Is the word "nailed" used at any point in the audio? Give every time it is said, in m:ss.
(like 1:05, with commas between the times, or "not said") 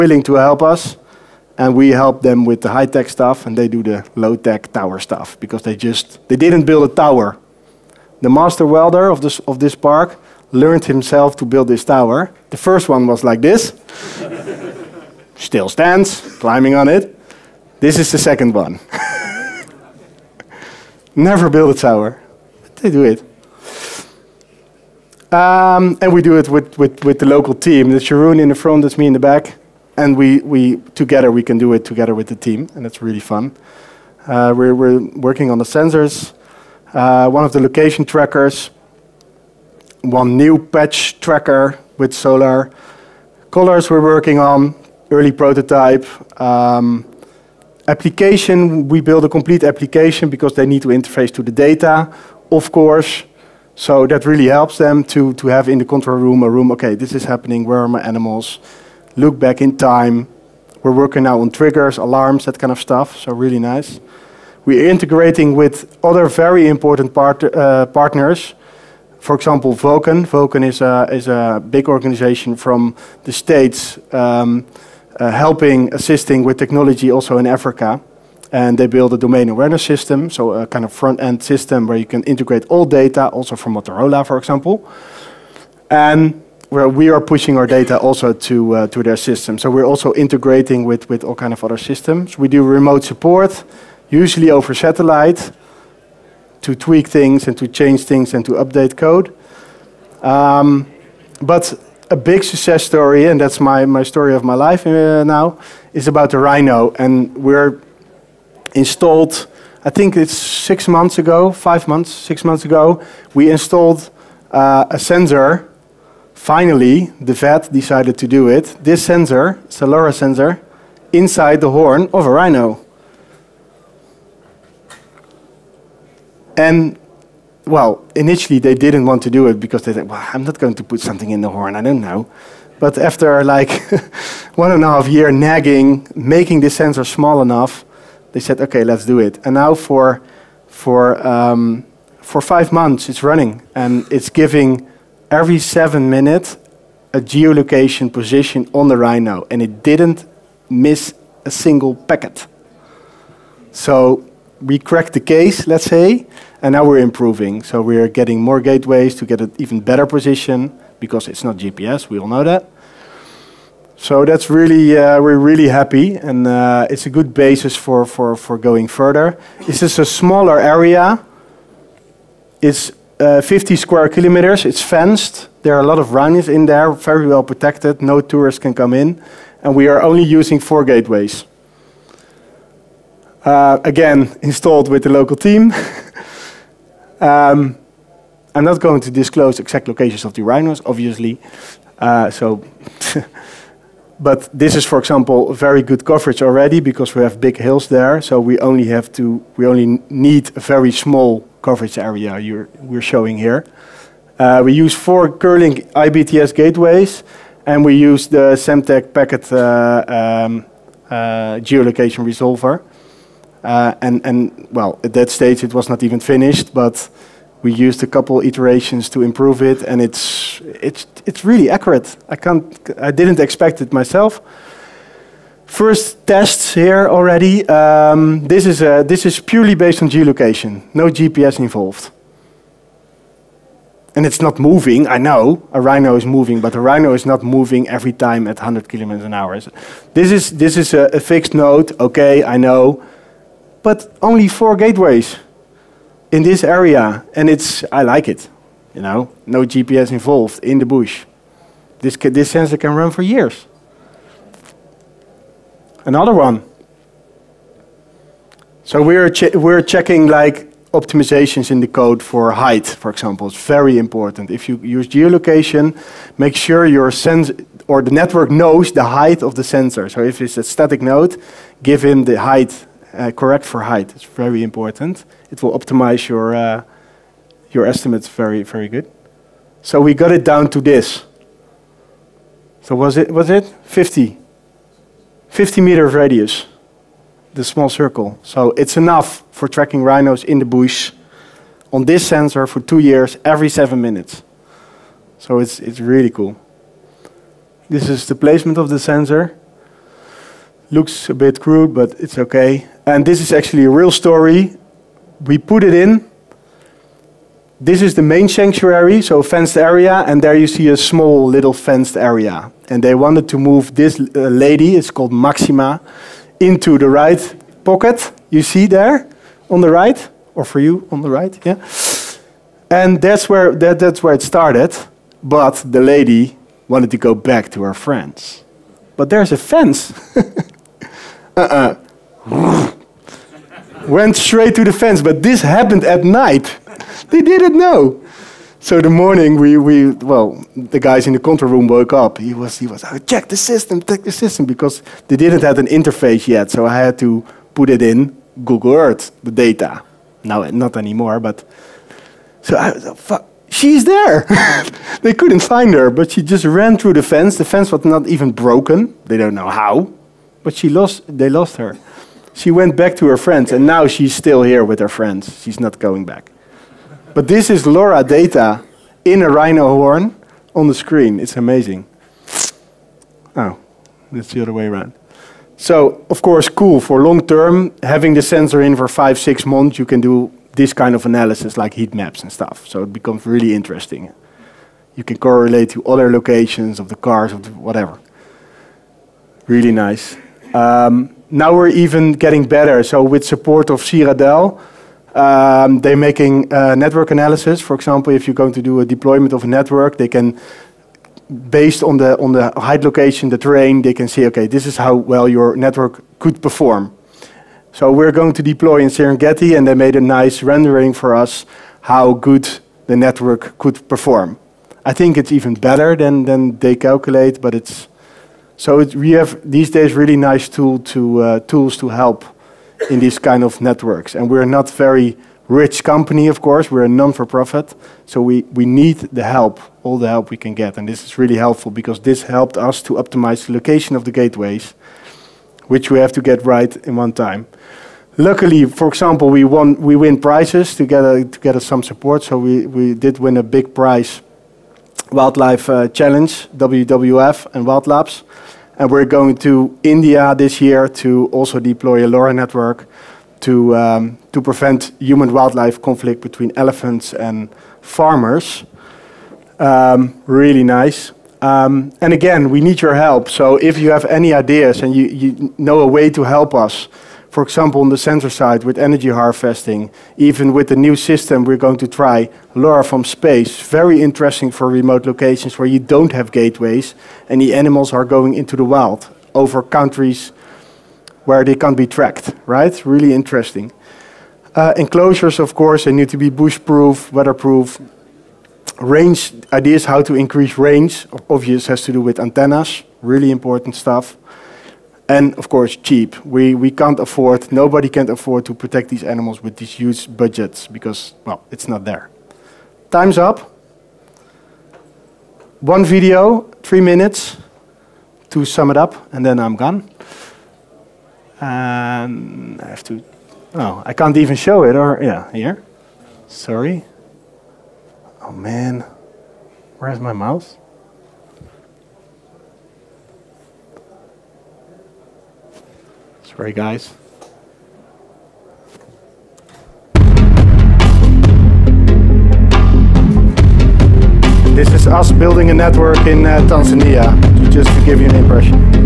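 not said.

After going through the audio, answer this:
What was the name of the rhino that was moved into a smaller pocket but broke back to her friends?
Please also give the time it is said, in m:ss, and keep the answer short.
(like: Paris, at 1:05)
Maxima, at 5:15.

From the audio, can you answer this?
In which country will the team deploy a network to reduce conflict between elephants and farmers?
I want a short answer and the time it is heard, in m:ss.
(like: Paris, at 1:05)
India, at 7:30.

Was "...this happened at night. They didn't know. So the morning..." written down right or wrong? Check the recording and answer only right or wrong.
right.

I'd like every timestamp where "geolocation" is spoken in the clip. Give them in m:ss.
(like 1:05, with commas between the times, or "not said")
2:27, 3:31, 3:50, 4:25.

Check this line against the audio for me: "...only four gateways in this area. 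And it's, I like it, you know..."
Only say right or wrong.
right.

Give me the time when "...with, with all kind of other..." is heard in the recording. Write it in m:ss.
1:30.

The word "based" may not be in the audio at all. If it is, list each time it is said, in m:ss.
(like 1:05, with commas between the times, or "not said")
3:49, 6:41.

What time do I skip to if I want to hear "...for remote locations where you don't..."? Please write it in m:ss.
7:54.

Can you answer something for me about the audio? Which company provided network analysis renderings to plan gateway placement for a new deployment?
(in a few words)
Siradel.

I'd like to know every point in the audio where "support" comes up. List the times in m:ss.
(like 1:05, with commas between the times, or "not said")
1:33, 6:33, 7:22.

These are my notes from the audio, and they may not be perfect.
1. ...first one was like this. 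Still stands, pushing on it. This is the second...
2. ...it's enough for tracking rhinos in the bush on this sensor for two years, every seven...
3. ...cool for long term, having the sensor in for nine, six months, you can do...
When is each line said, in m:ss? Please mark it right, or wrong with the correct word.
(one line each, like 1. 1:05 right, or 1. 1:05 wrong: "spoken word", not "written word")
1. 0:12 wrong: "climbing", not "pushing"
2. 4:48 right
3. 6:16 wrong: "five", not "nine".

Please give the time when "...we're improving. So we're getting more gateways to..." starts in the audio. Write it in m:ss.
2:36.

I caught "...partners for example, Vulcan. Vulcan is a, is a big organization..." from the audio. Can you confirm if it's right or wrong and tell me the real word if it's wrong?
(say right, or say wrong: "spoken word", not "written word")
right.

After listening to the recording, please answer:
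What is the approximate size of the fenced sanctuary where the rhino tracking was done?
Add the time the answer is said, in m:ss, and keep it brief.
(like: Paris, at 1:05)
50 square kilometers, at 2:53.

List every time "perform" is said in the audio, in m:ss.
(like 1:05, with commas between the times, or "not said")
6:46, 6:54.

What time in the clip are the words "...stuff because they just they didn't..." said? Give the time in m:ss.
0:04.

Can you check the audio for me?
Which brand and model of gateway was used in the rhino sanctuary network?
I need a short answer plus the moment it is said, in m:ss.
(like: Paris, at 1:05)
Kerlink IBTS, at 3:25.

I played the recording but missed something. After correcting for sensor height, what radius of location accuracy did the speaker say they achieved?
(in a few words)
50 meters.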